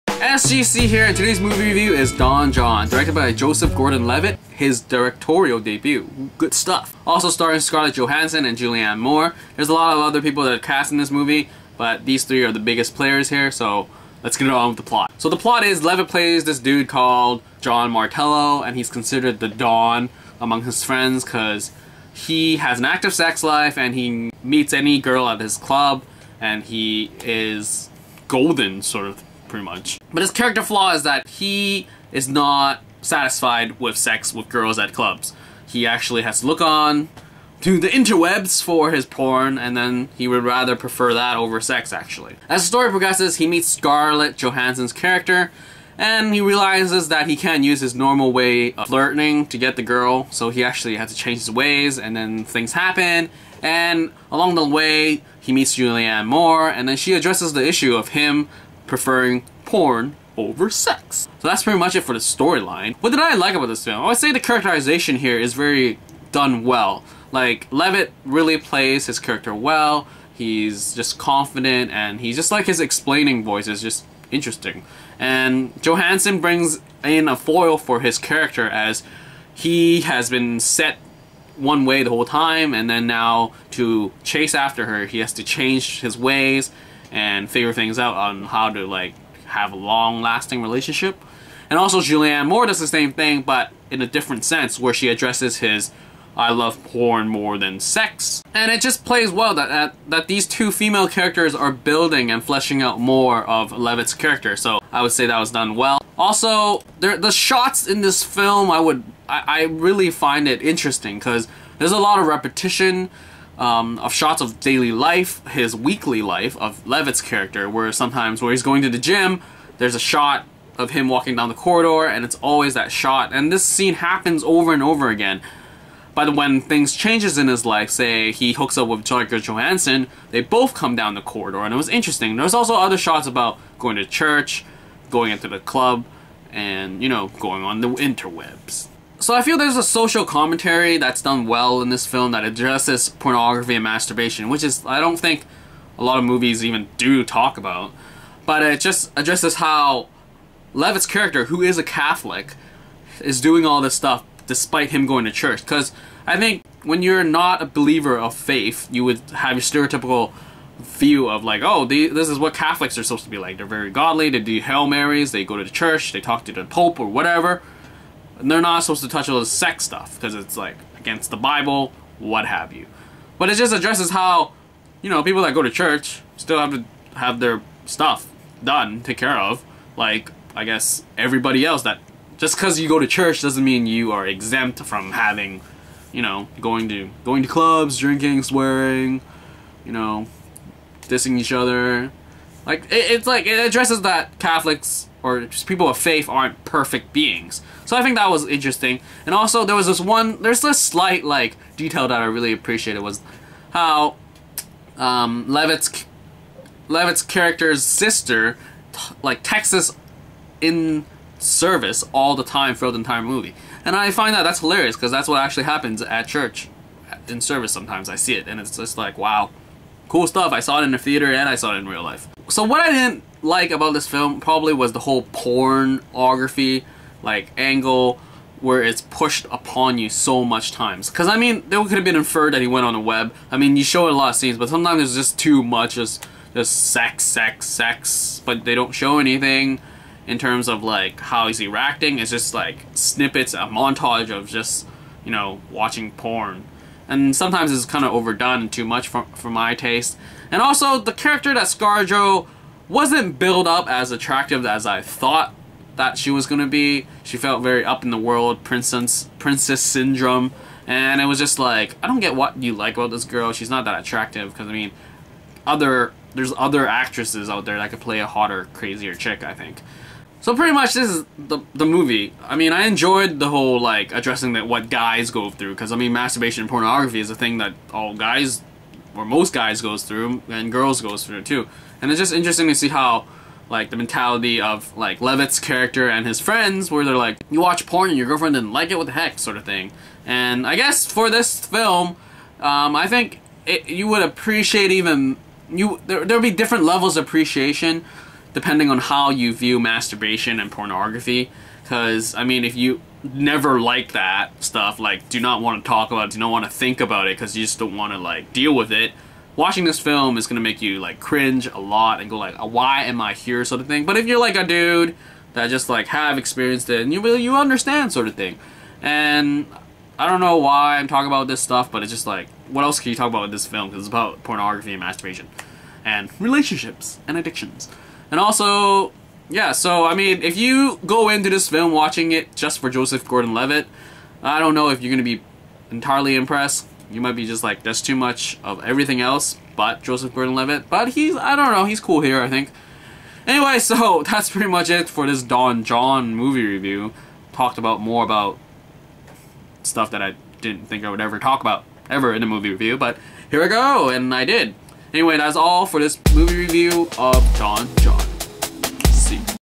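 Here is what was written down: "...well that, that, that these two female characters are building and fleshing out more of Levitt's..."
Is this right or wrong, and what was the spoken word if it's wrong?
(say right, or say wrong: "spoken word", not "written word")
right.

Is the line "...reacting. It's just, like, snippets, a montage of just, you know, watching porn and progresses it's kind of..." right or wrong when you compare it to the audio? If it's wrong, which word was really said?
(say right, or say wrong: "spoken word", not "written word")
wrong: "sometimes", not "progresses".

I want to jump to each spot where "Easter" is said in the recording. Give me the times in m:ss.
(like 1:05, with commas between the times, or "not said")
not said.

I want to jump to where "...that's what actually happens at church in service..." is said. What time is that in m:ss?
3:35.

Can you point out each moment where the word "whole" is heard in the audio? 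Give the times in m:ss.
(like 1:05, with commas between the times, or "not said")
1:22, 3:44, 4:33.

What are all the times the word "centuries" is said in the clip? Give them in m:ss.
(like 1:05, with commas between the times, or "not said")
not said.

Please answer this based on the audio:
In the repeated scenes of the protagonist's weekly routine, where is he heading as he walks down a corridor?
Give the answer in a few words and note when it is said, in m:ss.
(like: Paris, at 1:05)
the gym, at 1:58.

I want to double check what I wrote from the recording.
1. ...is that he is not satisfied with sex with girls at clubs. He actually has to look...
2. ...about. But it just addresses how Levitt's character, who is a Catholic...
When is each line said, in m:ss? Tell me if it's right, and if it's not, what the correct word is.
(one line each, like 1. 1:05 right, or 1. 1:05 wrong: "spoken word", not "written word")
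1. 0:30 right
2. 2:27 right.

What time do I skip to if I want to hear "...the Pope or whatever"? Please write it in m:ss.
2:46.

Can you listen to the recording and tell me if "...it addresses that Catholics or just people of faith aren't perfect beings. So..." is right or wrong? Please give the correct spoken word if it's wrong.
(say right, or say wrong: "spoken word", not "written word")
right.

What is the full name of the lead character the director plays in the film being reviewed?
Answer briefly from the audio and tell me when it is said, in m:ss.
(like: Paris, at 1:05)
Jon Martello, at 0:17.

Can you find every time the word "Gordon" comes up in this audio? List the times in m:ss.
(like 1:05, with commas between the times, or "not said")
0:03, 5:33, 5:40.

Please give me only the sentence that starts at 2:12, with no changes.
There's also other shots about going to church, going into the club, and you know, going on the interwebs.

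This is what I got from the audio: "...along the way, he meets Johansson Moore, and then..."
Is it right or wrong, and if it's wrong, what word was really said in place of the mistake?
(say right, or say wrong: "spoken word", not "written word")
wrong: "Julianne", not "Johansson".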